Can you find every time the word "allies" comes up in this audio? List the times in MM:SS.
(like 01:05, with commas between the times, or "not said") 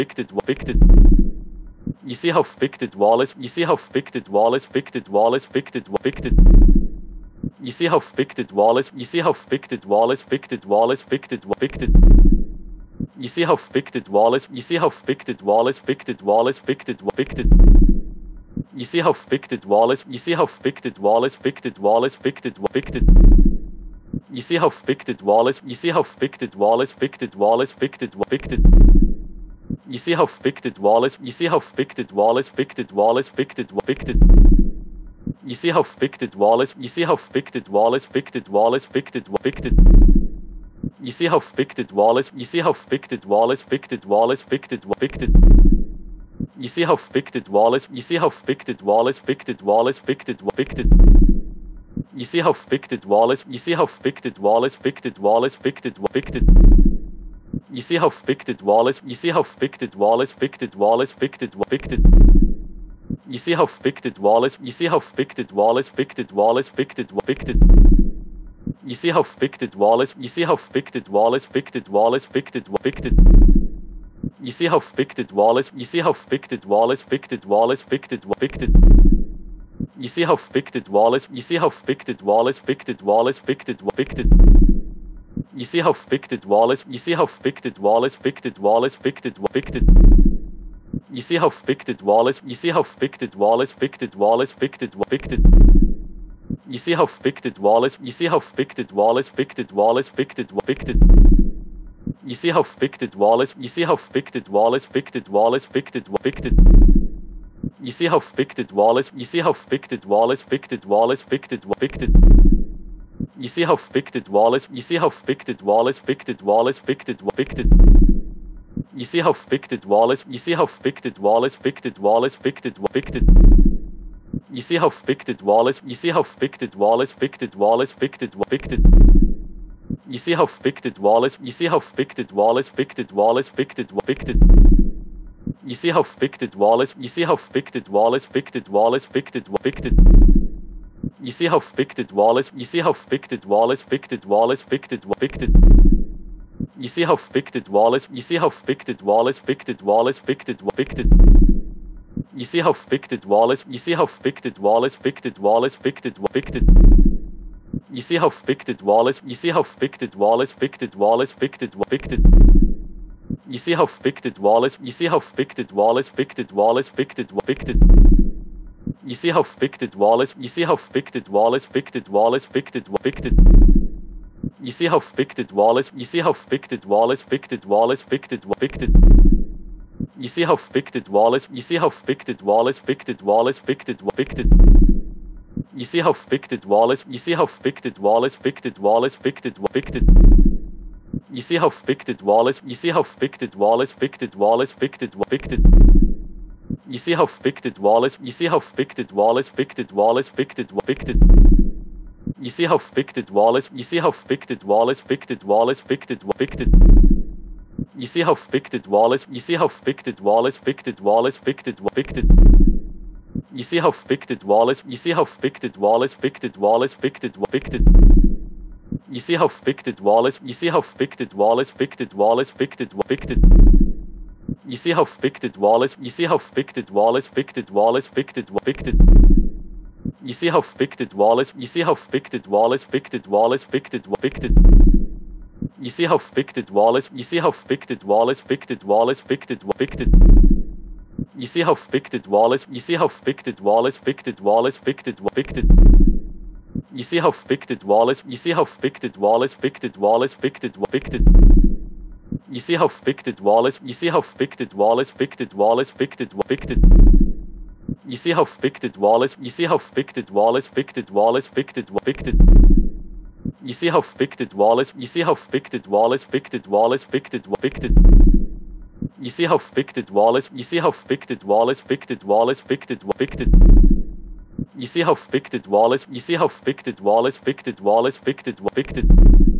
not said.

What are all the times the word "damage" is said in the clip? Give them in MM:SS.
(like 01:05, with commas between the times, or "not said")
not said.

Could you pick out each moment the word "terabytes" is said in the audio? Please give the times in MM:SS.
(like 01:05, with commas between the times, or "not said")
not said.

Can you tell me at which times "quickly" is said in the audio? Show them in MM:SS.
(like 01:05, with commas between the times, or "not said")
not said.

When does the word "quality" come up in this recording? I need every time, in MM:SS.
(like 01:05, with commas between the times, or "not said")
not said.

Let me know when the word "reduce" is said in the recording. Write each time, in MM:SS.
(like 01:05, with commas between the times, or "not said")
not said.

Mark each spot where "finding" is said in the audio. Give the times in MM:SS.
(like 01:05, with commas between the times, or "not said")
not said.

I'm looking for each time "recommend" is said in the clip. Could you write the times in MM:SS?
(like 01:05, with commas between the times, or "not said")
not said.